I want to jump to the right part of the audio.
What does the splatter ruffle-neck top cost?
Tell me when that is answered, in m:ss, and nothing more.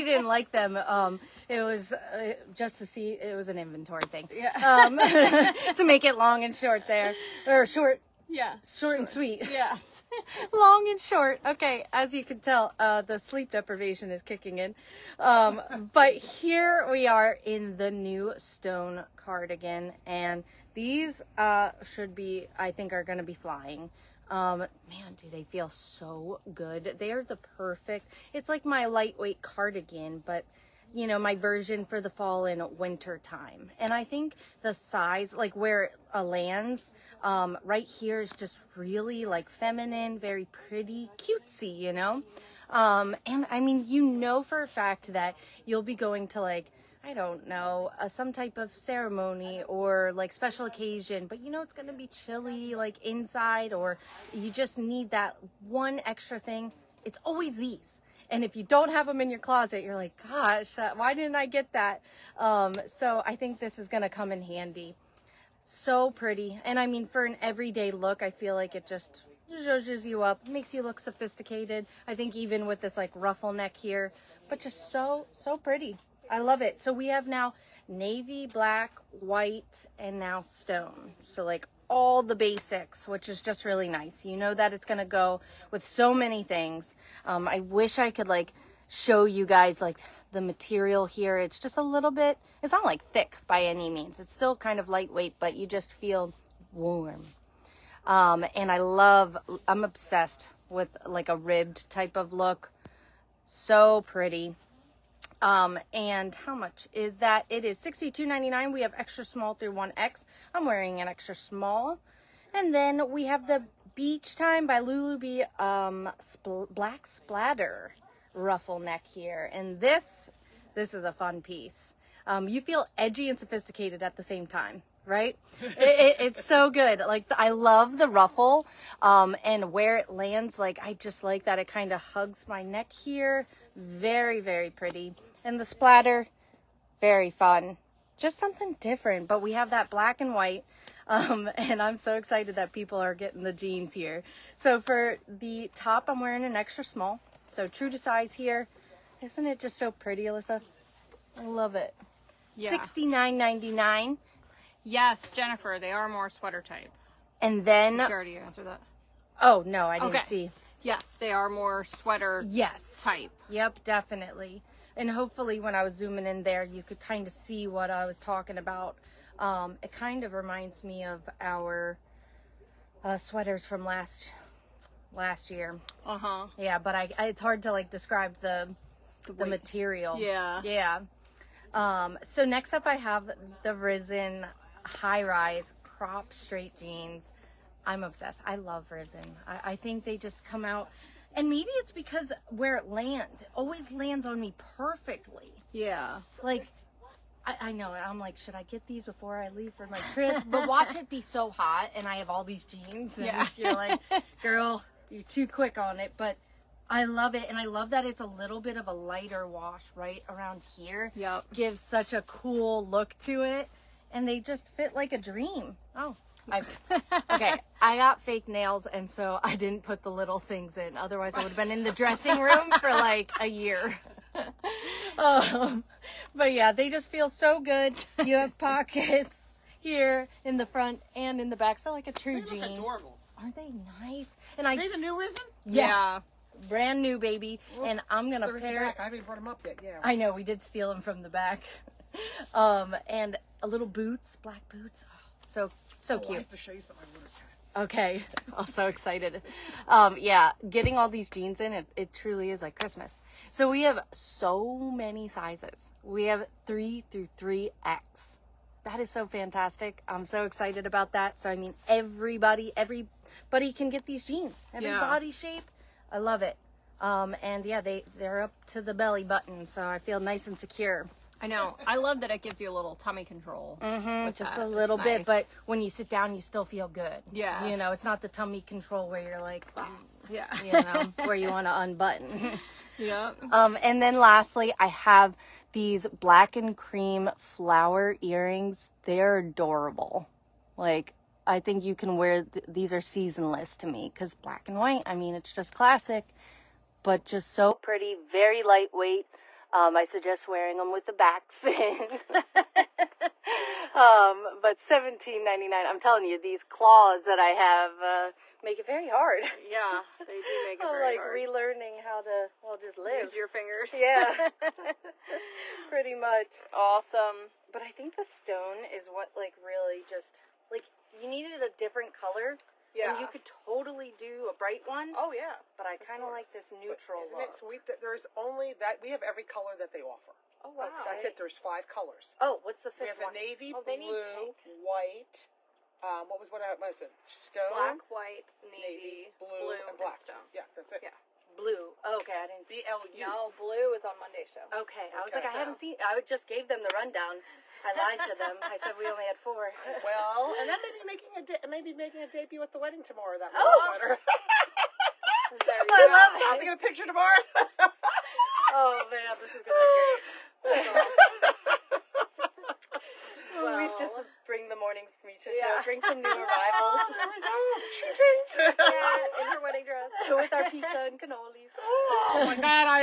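2:32.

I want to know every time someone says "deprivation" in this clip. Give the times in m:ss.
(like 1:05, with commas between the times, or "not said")
0:13.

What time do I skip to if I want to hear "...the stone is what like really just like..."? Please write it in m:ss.
5:18.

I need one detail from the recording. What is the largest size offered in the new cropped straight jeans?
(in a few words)
3X.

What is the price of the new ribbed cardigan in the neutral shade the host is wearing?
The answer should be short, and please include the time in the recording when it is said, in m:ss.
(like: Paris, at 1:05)
$62.99, at 1:47.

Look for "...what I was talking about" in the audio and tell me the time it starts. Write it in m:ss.
2:47.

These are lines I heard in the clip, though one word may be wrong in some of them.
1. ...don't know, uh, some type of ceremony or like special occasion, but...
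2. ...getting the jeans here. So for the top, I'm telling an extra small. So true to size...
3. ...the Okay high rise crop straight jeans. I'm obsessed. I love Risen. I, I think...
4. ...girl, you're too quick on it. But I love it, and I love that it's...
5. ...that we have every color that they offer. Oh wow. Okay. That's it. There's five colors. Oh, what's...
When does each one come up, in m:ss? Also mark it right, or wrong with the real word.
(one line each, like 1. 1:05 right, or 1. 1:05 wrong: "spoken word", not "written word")
1. 0:47 right
2. 2:23 wrong: "wearing", not "telling"
3. 3:03 wrong: "Risen", not "Okay"
4. 3:24 right
5. 5:28 right.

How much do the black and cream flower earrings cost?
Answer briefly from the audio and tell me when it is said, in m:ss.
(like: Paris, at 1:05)
$17.99, at 5:04.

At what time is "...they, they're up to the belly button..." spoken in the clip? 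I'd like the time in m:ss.
4:27.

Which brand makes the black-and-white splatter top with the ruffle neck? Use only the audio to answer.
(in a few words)
Lulu B.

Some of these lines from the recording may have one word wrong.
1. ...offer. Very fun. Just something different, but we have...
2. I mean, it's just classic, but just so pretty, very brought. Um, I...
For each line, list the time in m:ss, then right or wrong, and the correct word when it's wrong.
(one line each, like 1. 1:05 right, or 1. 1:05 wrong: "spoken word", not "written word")
1. 2:15 wrong: "splatter", not "offer"
2. 4:55 wrong: "lightweight", not "brought".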